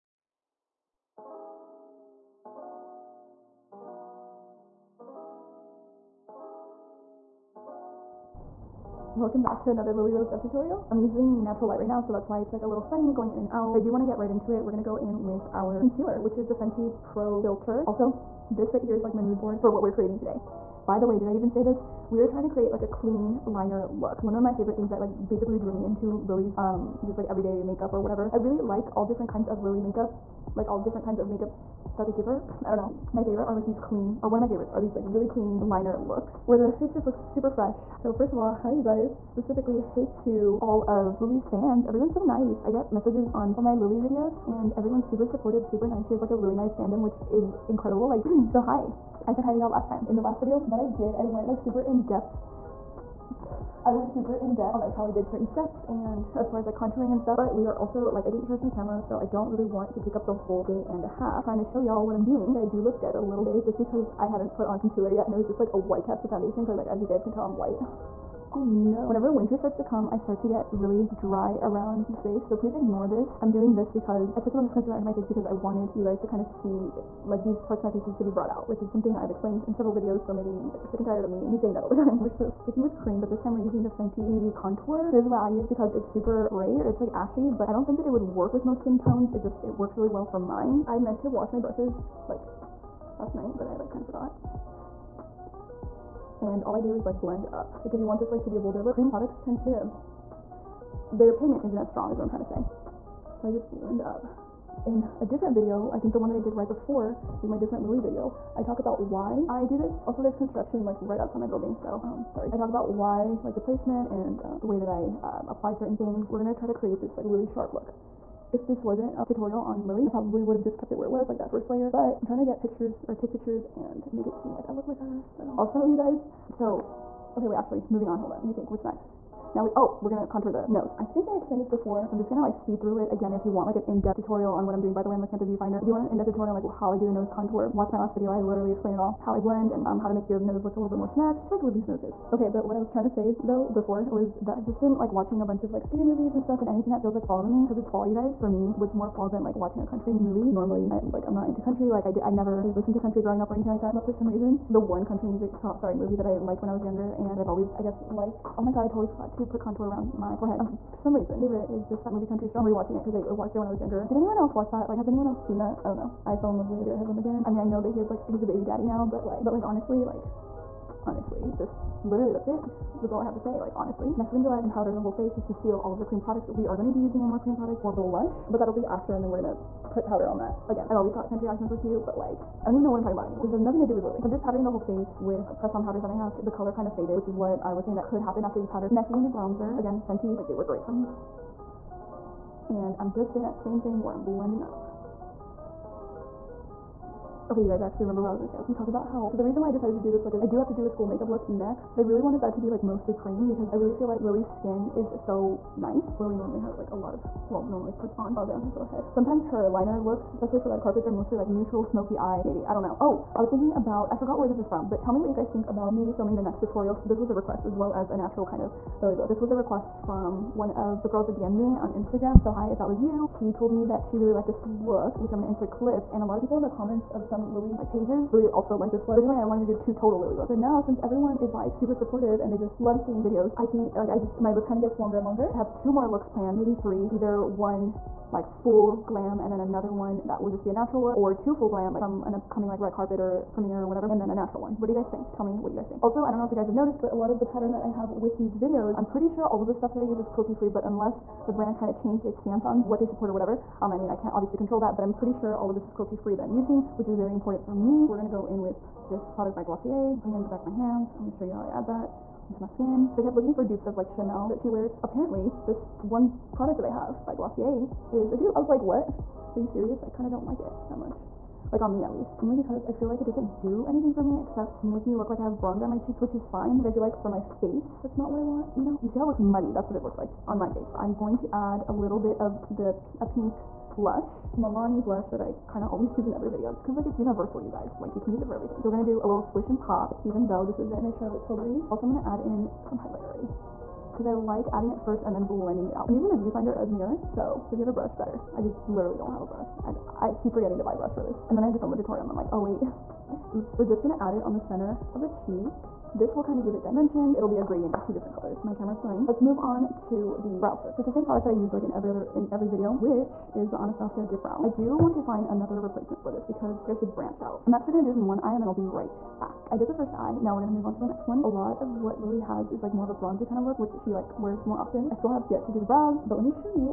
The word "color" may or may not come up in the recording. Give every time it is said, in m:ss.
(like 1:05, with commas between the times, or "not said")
3:06, 5:08.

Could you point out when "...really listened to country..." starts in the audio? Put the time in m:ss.
2:32.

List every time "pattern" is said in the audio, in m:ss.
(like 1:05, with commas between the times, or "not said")
4:07.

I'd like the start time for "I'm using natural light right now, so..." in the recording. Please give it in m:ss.
0:10.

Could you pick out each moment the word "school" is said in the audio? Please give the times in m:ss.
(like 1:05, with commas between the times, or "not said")
3:20.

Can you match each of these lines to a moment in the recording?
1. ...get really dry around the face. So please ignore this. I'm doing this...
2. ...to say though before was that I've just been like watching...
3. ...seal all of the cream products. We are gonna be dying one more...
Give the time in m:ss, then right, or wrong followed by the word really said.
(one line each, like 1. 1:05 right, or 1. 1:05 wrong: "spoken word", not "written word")
1. 1:10 right
2. 2:23 right
3. 2:55 wrong: "using", not "dying".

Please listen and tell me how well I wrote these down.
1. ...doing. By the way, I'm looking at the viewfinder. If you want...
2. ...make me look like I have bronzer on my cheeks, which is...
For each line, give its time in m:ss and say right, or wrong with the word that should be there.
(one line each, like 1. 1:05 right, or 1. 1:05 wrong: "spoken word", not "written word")
1. 2:14 right
2. 4:34 right.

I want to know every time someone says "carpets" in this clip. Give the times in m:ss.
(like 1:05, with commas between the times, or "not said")
3:30, 4:02.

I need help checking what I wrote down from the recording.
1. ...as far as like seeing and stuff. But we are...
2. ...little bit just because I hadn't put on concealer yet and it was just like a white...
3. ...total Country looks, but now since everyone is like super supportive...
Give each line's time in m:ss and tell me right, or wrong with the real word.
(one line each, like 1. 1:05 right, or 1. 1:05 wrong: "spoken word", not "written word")
1. 0:56 wrong: "contouring", not "seeing"
2. 1:03 right
3. 3:49 wrong: "Lily", not "Country".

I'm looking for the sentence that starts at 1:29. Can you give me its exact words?
It just, it works really well for mine.